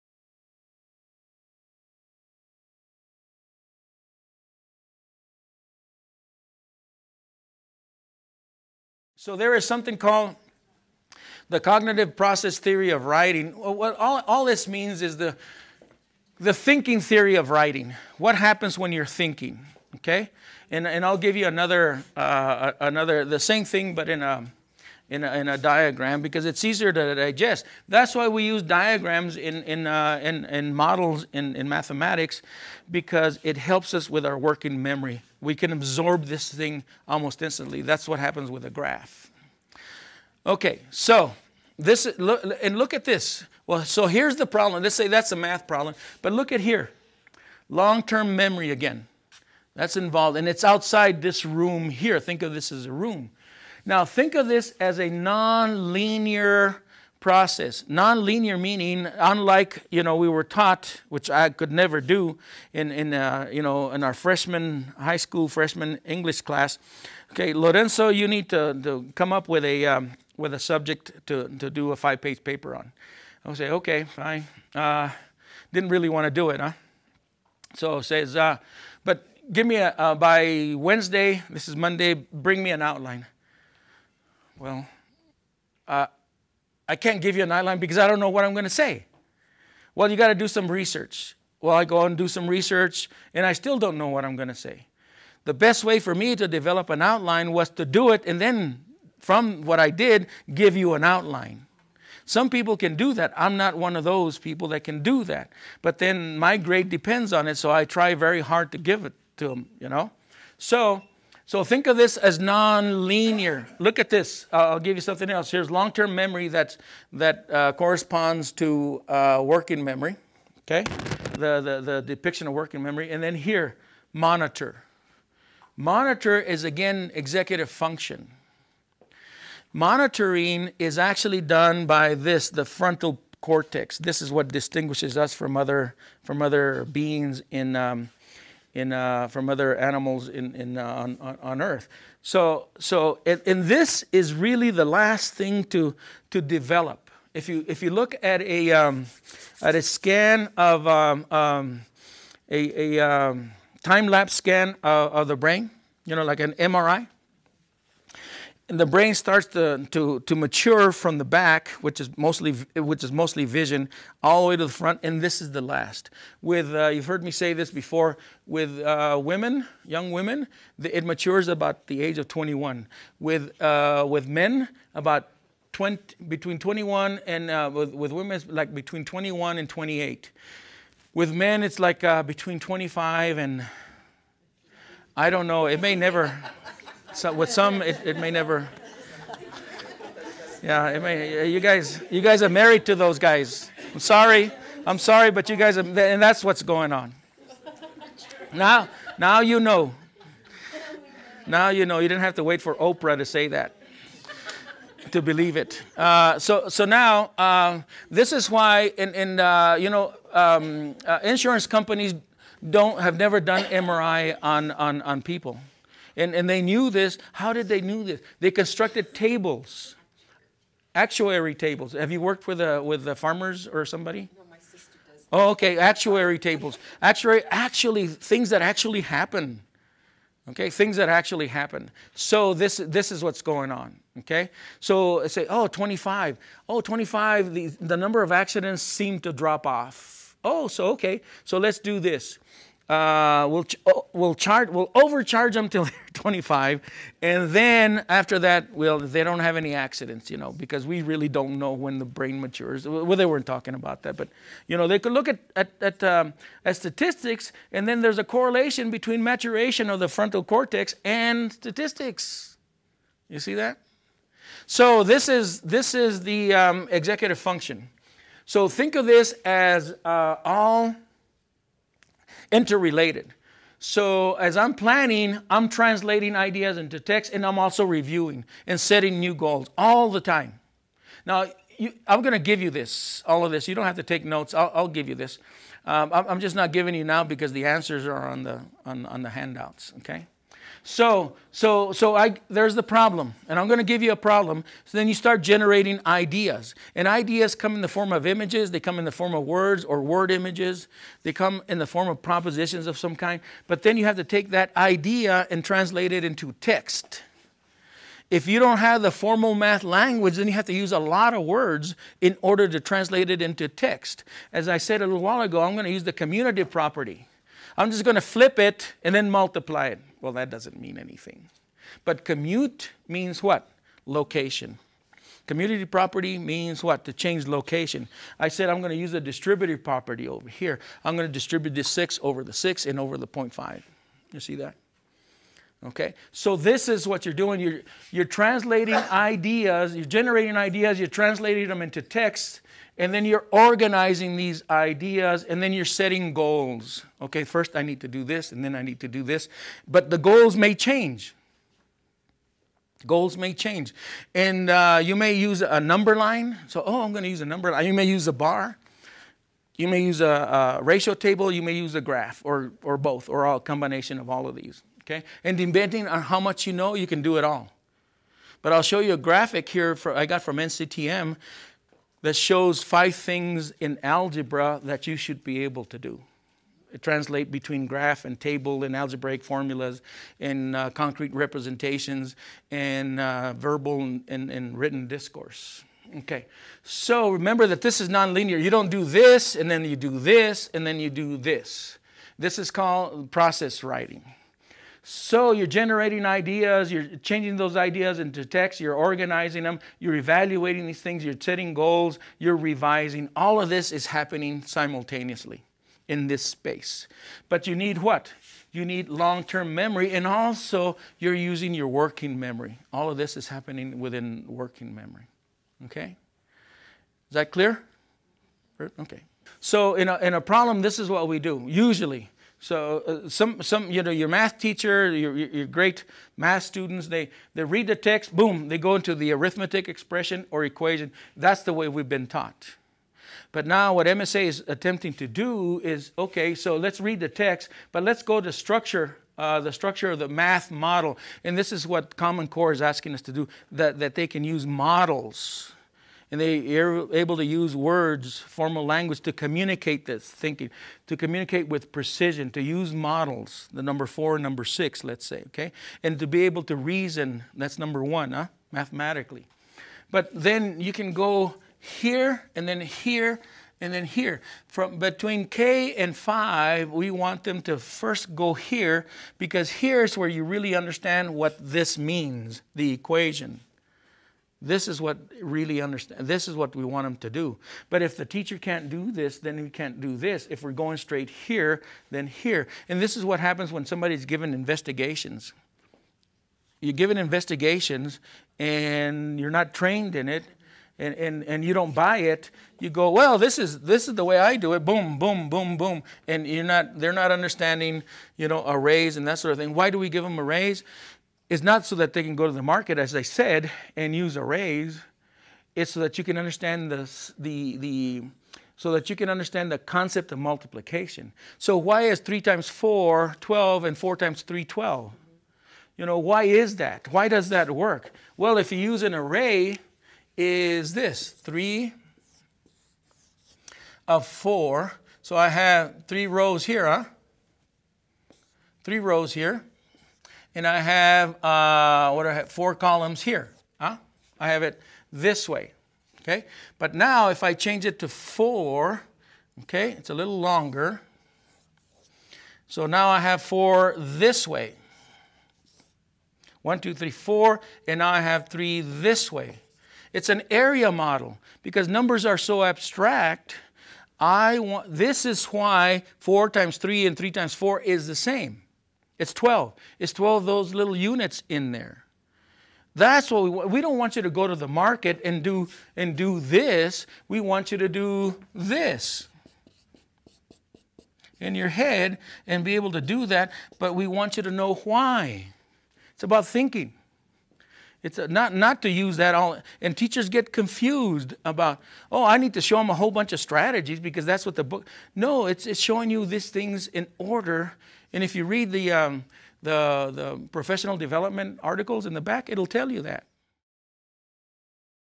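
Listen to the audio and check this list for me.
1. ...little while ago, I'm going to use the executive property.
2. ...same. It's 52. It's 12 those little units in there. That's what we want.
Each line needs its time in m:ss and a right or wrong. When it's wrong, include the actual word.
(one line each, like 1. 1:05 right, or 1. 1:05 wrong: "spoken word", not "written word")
1. 5:15 wrong: "commutative", not "executive"
2. 9:18 wrong: "12", not "52".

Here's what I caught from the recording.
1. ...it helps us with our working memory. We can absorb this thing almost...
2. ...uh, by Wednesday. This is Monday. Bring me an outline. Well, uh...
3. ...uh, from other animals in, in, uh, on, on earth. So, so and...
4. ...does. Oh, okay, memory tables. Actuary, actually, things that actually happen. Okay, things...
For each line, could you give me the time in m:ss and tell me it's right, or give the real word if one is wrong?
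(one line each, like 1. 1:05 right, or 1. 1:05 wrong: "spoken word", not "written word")
1. 0:33 right
2. 1:19 right
3. 2:18 right
4. 3:45 wrong: "actuary", not "memory".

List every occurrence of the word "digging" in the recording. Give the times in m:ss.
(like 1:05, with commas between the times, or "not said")
not said.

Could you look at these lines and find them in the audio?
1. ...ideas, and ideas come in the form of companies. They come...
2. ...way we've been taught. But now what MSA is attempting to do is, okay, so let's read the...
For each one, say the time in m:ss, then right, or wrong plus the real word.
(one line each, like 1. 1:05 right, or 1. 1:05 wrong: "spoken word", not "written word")
1. 4:56 wrong: "images", not "companies"
2. 7:11 right.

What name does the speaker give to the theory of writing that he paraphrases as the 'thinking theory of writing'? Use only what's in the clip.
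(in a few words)
cognitive process theory.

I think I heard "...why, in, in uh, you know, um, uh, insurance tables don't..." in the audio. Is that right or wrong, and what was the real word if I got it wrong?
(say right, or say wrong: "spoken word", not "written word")
wrong: "companies", not "tables".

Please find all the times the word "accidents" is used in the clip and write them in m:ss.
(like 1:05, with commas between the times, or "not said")
3:58, 4:09.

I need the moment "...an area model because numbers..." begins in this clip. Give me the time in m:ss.
9:10.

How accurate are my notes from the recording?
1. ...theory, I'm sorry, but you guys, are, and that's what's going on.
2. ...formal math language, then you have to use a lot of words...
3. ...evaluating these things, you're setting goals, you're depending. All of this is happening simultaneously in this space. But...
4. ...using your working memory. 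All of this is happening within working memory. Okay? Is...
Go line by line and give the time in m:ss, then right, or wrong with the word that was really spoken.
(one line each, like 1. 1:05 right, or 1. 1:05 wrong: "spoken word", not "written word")
1. 3:13 wrong: "sorry", not "theory"
2. 5:09 right
3. 6:40 wrong: "revising", not "depending"
4. 6:51 right.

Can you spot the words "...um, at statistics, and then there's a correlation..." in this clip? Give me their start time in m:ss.
4:16.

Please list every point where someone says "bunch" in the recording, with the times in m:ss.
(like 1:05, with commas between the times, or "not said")
9:43.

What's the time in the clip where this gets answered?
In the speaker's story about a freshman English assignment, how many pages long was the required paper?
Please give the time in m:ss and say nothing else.
1:11.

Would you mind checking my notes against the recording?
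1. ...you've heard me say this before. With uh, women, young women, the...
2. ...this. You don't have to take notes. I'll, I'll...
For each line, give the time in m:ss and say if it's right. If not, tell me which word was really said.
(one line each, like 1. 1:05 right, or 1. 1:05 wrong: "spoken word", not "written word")
1. 2:46 right
2. 4:43 right.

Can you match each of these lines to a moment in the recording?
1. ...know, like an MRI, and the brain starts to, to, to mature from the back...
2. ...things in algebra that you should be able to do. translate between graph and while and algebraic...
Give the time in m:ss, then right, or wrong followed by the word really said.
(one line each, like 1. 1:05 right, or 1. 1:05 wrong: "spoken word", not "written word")
1. 2:36 right
2. 6:13 wrong: "table", not "while".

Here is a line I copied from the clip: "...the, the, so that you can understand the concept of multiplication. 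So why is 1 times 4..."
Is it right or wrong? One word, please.
wrong.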